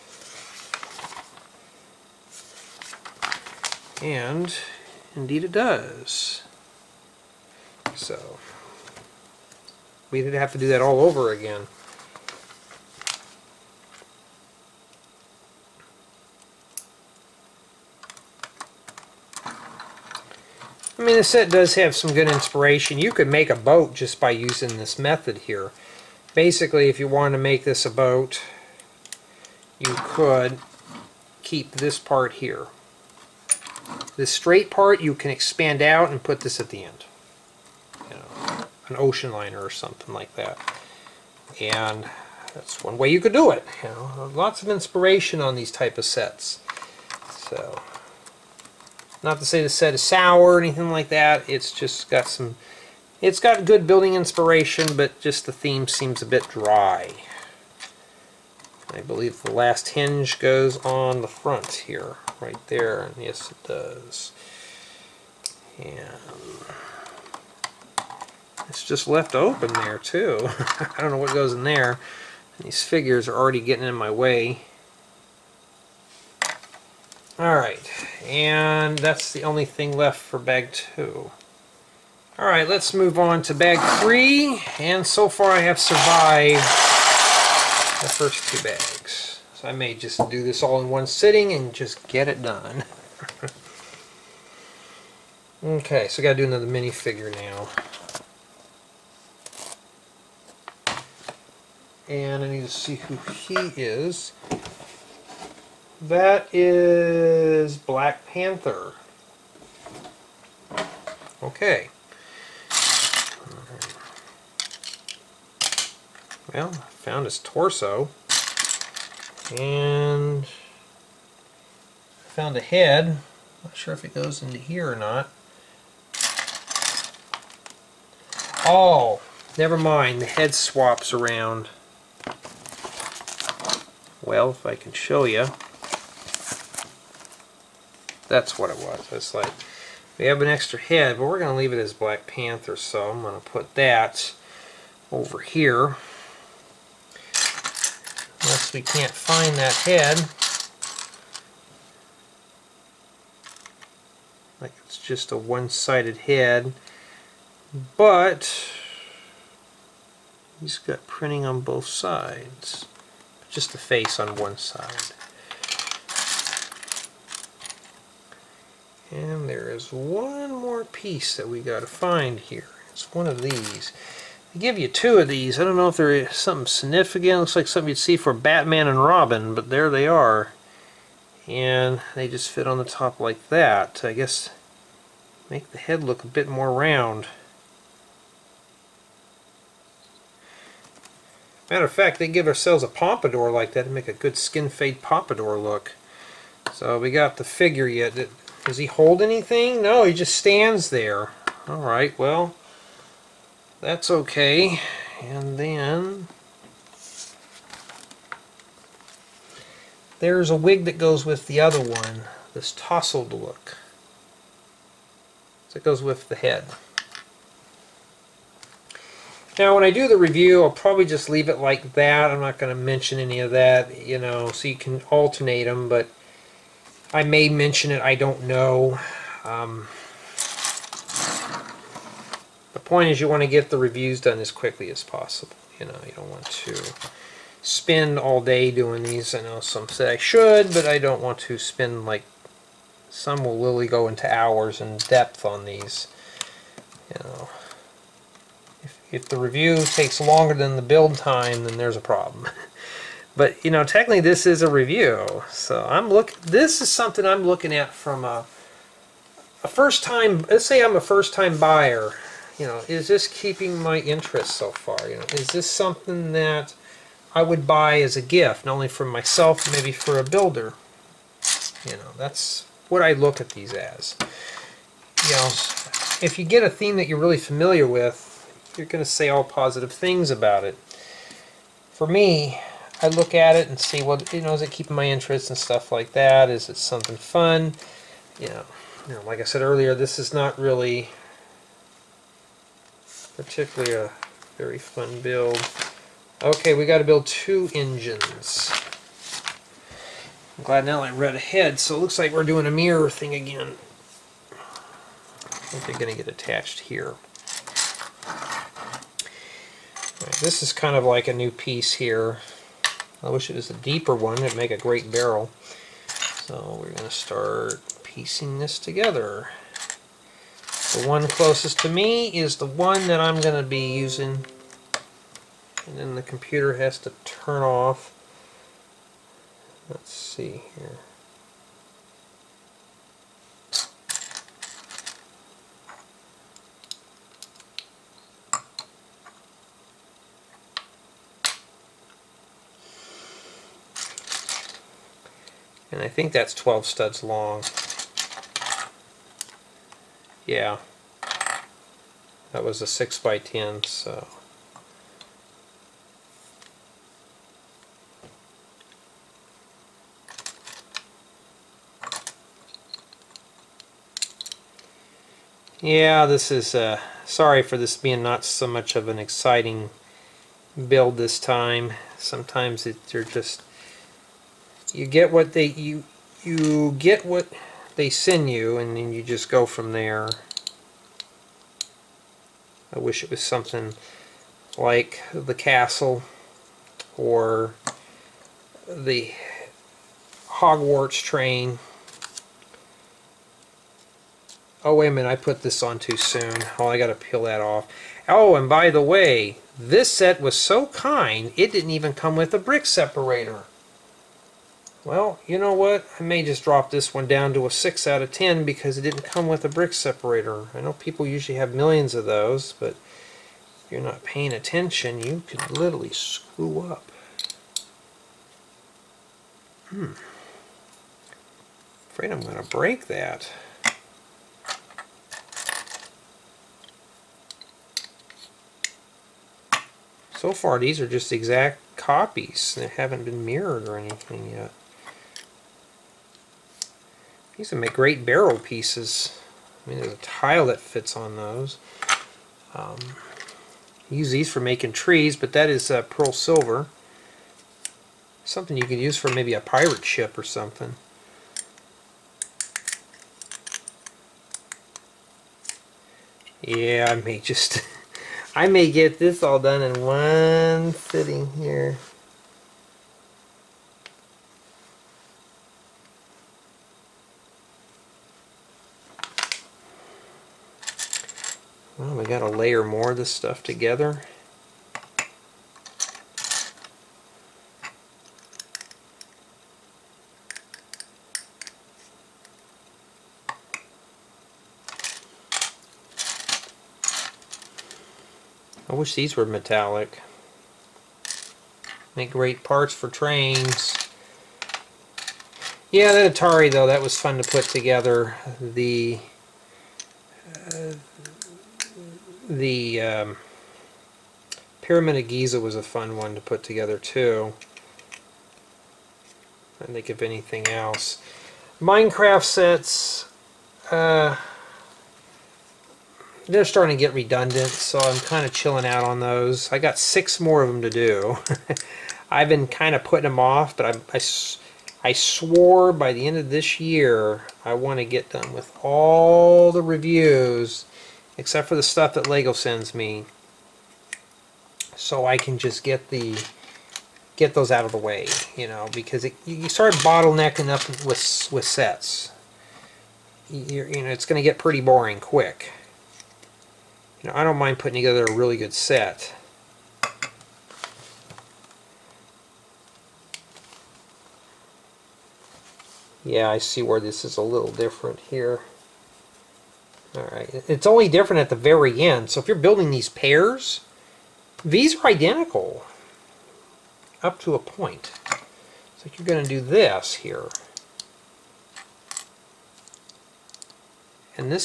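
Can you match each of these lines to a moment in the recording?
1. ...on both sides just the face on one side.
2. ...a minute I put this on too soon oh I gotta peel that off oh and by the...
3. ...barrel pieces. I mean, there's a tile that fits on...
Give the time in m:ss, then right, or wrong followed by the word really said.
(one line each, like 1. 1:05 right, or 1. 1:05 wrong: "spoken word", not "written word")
1. 2:41 right
2. 6:35 right
3. 7:18 right.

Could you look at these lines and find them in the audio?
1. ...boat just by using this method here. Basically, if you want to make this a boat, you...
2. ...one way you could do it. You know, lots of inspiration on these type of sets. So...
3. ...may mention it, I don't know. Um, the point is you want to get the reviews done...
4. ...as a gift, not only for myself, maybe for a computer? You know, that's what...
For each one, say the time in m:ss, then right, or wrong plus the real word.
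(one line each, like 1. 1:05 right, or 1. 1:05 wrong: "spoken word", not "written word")
1. 0:23 right
2. 0:42 right
3. 3:47 right
4. 4:28 wrong: "builder", not "computer".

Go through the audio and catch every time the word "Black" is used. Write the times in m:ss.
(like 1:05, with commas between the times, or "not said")
1:47, 2:21.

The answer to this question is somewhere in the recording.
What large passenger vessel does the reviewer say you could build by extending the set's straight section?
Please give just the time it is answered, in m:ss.
0:38.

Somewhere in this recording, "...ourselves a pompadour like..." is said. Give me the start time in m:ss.
3:12.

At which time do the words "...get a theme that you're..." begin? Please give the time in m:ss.
4:36.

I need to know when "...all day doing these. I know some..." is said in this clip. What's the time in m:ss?
3:58.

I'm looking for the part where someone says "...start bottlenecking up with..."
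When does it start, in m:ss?
8:59.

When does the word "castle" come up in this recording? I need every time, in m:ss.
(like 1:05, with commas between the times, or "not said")
6:25.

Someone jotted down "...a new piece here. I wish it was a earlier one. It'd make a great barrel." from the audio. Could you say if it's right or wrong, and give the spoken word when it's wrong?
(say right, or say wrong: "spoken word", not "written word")
wrong: "deeper", not "earlier".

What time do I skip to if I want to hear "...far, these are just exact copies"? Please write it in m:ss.
7:10.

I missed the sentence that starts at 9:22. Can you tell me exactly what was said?
So if you're building these pairs, these are identical up to a point.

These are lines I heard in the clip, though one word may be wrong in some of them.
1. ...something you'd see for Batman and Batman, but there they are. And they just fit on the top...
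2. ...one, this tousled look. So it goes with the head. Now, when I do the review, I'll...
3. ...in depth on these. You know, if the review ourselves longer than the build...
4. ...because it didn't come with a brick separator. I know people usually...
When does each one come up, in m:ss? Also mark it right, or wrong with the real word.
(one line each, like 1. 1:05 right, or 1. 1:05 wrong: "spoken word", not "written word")
1. 2:57 wrong: "Robin", not "Batman"
2. 3:31 right
3. 4:04 wrong: "takes", not "ourselves"
4. 6:48 right.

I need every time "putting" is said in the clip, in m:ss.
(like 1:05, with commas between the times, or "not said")
8:43, 9:07.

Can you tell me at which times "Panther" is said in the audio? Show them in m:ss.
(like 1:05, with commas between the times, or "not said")
1:48, 2:22.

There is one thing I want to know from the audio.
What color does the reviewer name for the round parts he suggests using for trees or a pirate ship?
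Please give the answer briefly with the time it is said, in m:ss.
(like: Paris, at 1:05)
Pearl silver, at 7:26.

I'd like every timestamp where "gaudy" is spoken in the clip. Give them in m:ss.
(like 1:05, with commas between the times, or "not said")
not said.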